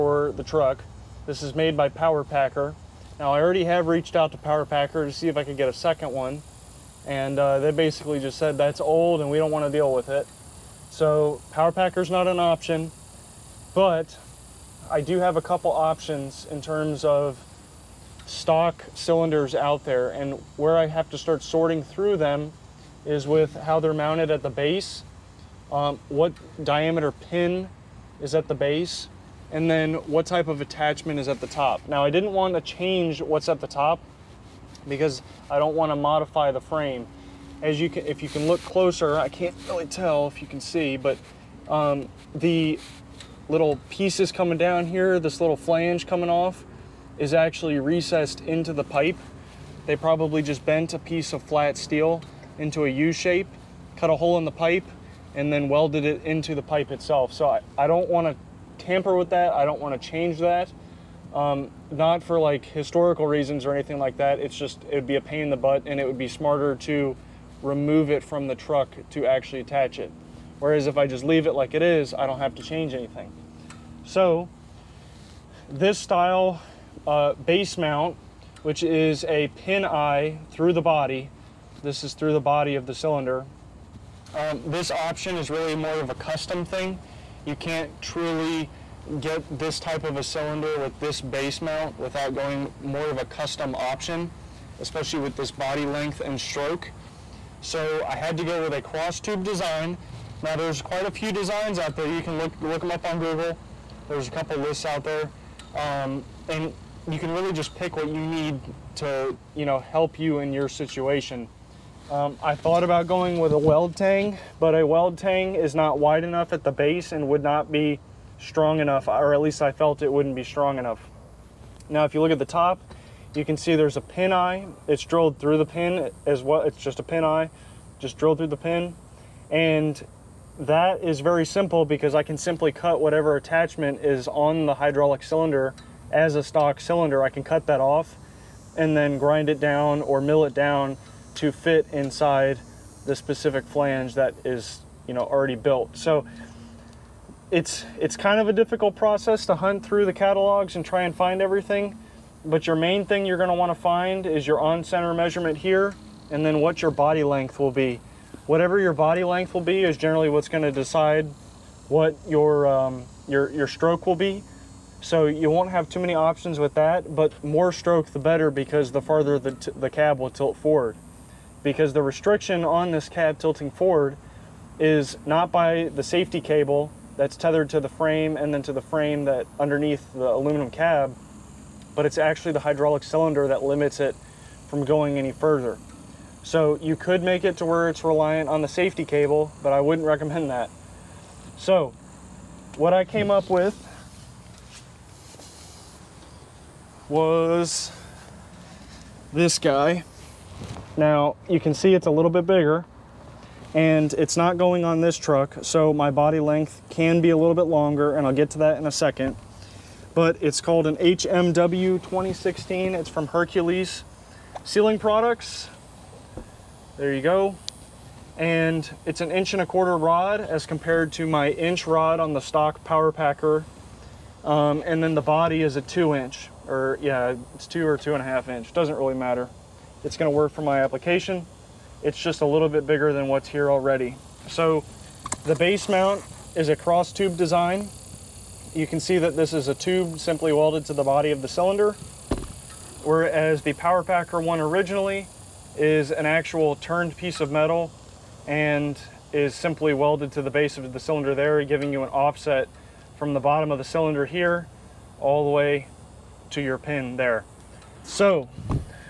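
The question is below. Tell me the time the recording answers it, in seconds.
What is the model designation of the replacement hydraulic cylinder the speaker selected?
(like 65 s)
210 s.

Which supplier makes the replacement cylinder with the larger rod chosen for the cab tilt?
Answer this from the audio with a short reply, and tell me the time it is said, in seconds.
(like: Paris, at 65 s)
Hercules Sealing Products, at 213 s.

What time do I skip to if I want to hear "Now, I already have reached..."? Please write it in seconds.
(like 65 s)
3 s.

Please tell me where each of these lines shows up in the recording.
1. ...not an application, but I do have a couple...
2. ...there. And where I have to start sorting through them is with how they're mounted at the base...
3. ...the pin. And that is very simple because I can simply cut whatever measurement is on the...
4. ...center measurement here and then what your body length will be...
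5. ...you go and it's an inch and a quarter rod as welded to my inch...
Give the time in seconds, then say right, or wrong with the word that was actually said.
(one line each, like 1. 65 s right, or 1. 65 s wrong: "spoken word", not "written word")
1. 12 s wrong: "option", not "application"
2. 19 s right
3. 128 s wrong: "attachment", not "measurement"
4. 154 s right
5. 217 s wrong: "compared", not "welded".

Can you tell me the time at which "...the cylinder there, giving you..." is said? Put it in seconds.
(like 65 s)
250 s.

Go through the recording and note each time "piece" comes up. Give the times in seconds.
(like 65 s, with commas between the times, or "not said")
43 s, 50 s, 247 s.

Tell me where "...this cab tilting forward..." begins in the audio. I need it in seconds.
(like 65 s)
172 s.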